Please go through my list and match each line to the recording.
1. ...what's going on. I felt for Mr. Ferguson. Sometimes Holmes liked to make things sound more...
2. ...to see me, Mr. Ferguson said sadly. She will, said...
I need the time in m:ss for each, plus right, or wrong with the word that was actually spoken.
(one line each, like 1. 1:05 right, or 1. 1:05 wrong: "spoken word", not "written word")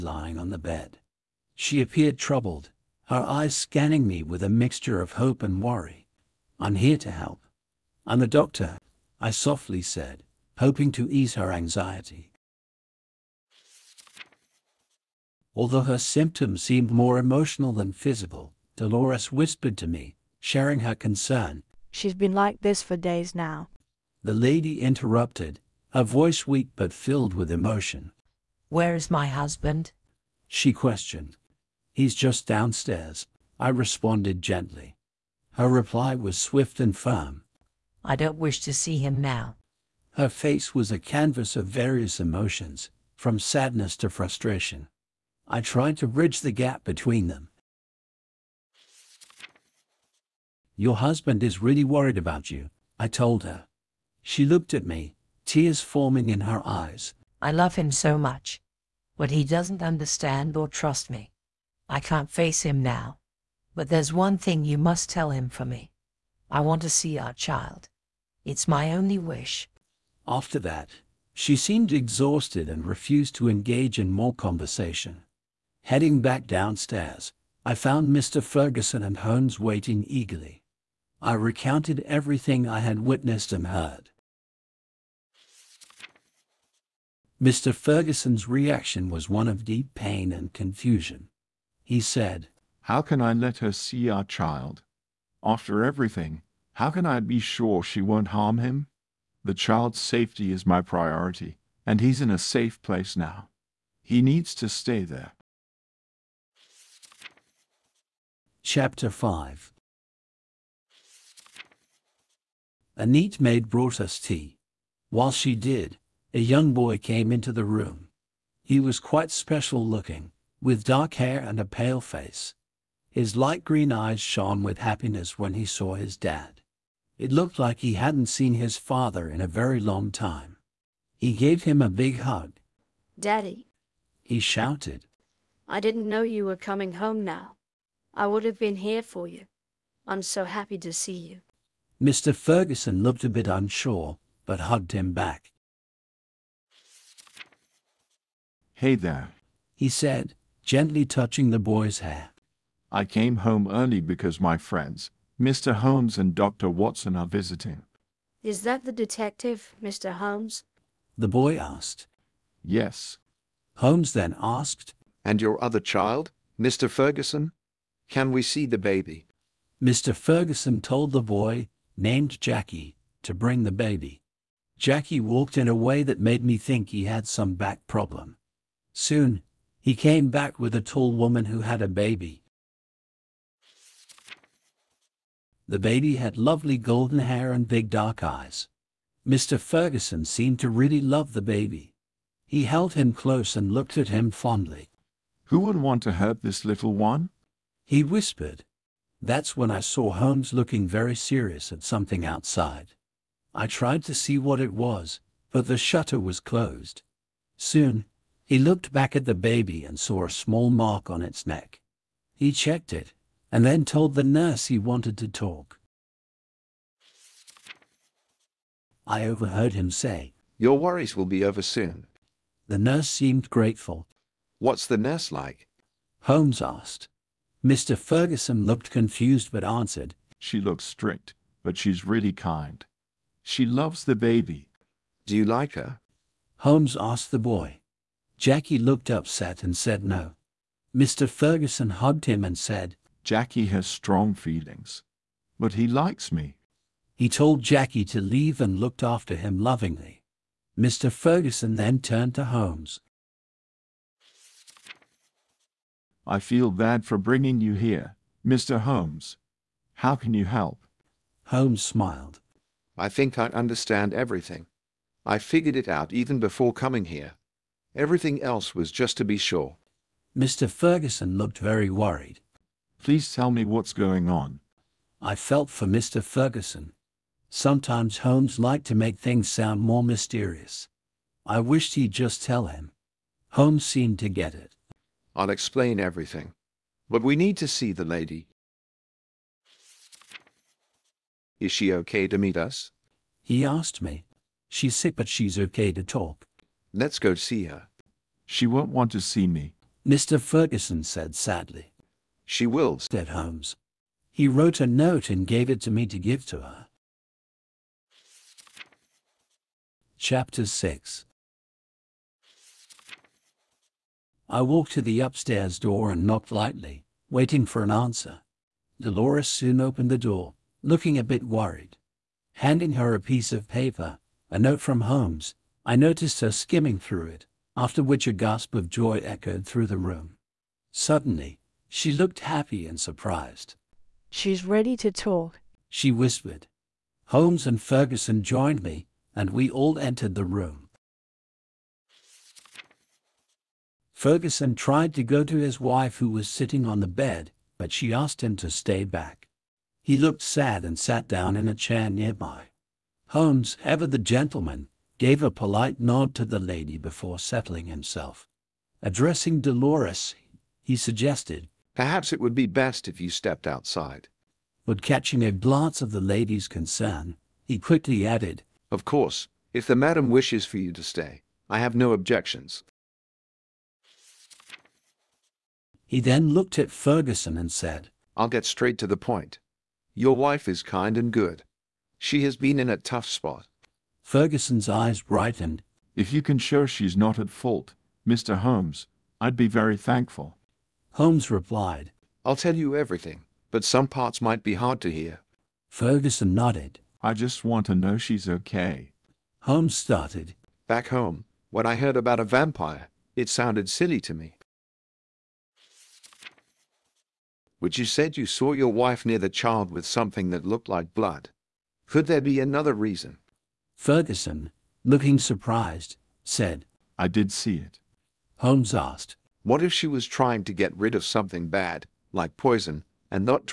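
1. 4:33 right
2. 4:59 right.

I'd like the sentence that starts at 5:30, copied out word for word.
Suddenly, she looked happy and surprised.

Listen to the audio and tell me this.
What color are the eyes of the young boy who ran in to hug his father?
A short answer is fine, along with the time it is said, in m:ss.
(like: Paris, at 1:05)
Light green, at 2:03.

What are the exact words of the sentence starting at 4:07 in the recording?
He told Jackie to leave and looked after him lovingly.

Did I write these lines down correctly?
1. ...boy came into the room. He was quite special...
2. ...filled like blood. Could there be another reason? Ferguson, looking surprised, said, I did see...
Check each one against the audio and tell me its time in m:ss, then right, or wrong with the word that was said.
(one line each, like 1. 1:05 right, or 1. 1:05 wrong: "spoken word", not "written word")
1. 1:56 right
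2. 6:50 wrong: "looked", not "filled".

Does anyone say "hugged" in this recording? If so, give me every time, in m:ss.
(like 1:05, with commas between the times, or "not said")
2:24, 4:01.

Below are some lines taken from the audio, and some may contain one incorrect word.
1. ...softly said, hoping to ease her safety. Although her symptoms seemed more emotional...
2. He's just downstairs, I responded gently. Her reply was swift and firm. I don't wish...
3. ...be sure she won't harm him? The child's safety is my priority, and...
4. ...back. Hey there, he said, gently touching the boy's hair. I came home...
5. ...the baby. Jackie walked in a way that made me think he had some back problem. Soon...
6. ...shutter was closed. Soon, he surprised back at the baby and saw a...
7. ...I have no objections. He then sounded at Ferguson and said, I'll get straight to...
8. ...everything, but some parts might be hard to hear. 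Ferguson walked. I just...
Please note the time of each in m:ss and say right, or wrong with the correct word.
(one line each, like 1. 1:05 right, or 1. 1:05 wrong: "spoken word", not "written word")
1. 0:09 wrong: "anxiety", not "safety"
2. 0:31 right
3. 1:37 right
4. 2:25 right
5. 2:53 right
6. 3:25 wrong: "looked", not "surprised"
7. 6:11 wrong: "looked", not "sounded"
8. 6:32 wrong: "nodded", not "walked".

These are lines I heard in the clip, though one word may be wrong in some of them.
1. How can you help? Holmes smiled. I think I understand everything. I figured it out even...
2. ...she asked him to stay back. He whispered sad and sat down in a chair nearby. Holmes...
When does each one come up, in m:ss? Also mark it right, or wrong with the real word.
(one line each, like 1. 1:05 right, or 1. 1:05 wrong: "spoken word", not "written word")
1. 4:20 right
2. 5:47 wrong: "looked", not "whispered".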